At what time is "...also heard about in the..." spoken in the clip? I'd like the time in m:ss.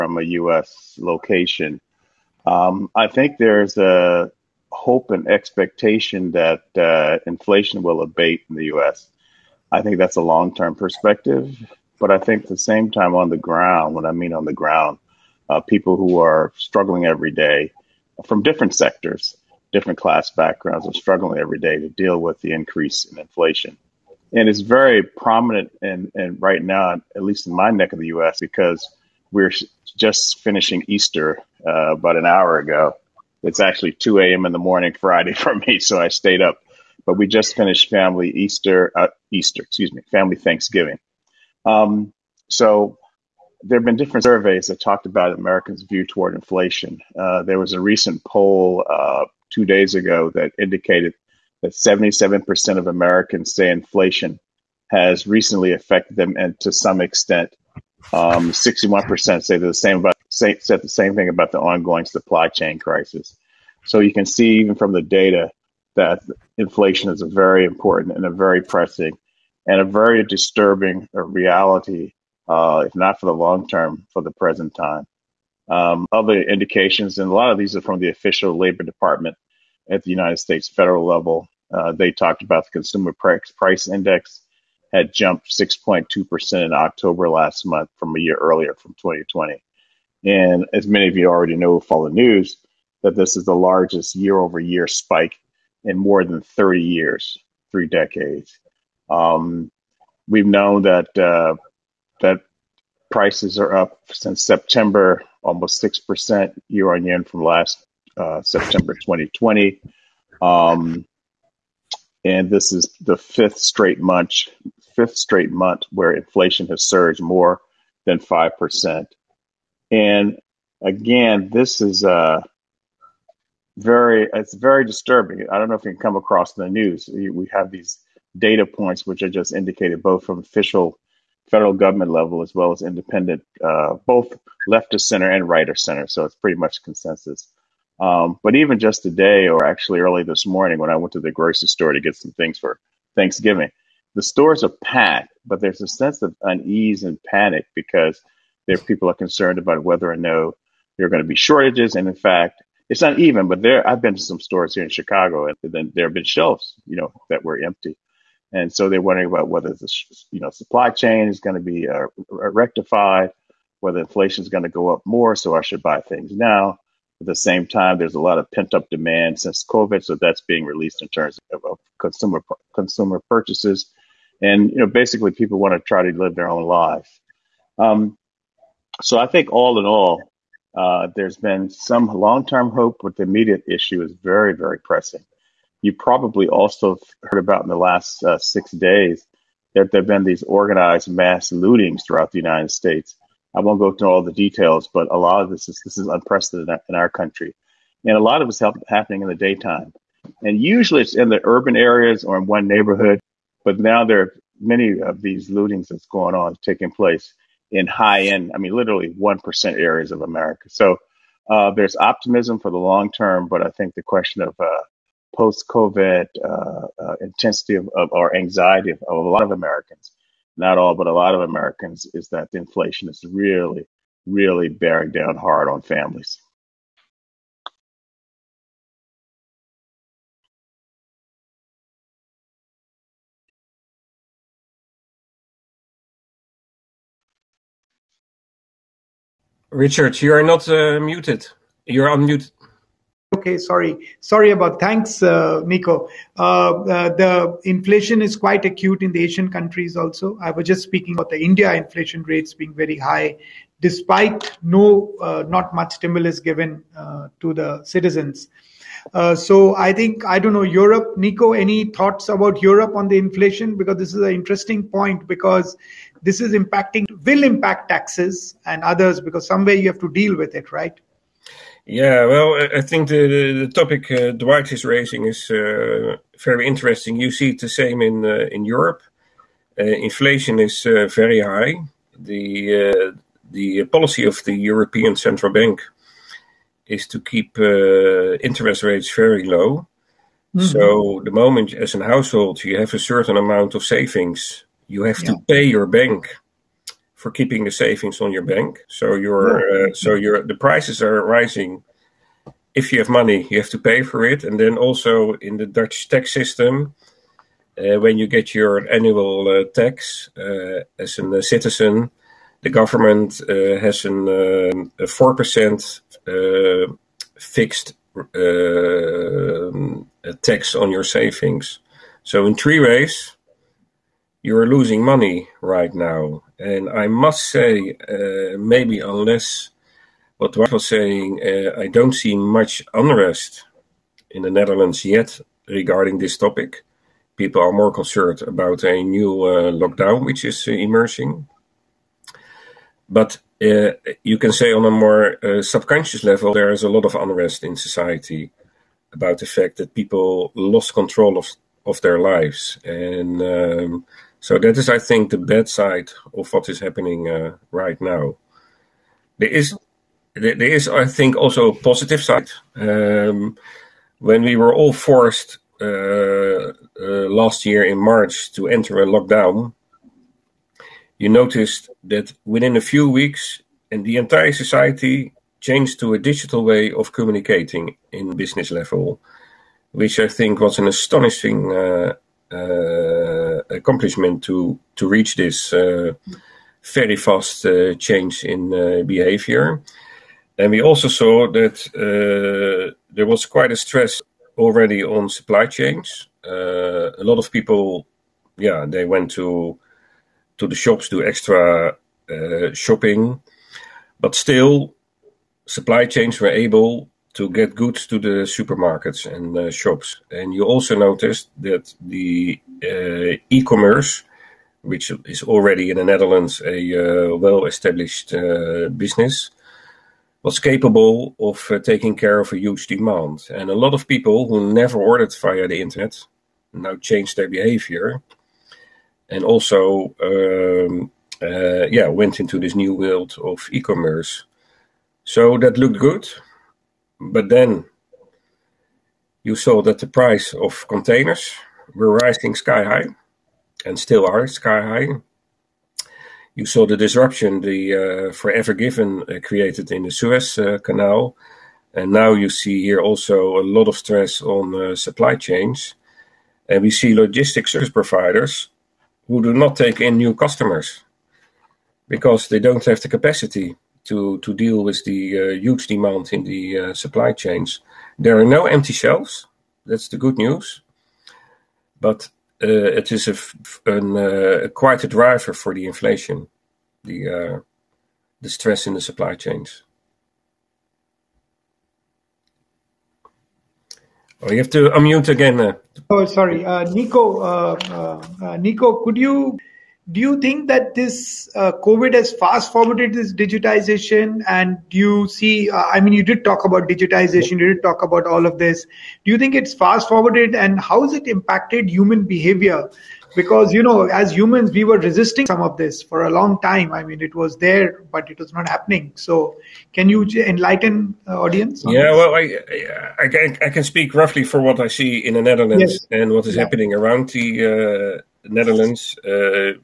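3:06.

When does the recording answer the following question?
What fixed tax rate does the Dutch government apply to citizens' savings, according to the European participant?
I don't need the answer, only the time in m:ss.
5:15.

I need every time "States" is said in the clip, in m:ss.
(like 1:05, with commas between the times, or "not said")
1:20, 3:12.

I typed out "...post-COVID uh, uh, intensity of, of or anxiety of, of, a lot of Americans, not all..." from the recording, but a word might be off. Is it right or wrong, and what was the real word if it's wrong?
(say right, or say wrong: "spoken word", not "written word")
right.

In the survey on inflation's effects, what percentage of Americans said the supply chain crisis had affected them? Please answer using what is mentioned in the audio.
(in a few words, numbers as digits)
61%.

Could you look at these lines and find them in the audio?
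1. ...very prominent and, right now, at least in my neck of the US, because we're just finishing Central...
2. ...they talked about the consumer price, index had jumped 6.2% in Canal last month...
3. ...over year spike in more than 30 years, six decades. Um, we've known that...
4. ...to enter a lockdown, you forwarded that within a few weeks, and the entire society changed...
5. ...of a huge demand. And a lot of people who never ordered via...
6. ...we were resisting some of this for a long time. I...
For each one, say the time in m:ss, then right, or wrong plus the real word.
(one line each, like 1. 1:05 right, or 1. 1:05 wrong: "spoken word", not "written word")
1. 0:24 wrong: "Easter", not "Central"
2. 1:21 wrong: "October", not "Canal"
3. 1:34 wrong: "three", not "six"
4. 6:08 wrong: "noticed", not "forwarded"
5. 7:02 right
6. 8:24 right.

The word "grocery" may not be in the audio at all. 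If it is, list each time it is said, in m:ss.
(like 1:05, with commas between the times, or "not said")
2:21.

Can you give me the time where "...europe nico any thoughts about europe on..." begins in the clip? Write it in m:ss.
4:20.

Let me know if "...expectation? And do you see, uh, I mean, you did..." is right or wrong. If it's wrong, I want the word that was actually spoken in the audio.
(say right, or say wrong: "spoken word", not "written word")
wrong: "digitization", not "expectation".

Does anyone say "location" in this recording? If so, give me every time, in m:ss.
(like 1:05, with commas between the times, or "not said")
0:00.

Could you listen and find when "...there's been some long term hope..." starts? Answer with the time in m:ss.
3:01.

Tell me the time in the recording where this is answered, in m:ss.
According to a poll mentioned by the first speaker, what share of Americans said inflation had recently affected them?
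0:51.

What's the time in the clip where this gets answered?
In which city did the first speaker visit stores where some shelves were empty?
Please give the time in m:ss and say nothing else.
2:34.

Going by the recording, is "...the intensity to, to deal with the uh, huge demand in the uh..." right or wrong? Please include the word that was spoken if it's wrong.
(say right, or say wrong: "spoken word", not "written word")
wrong: "capacity", not "intensity".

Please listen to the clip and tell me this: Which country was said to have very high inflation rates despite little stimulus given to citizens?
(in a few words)
India.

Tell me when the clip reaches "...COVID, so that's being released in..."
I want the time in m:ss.
2:49.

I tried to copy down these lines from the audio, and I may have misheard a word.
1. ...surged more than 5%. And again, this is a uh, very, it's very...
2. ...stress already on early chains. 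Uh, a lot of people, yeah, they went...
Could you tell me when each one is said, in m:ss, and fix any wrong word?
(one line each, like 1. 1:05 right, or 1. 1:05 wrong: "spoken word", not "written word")
1. 1:56 right
2. 6:33 wrong: "supply", not "early".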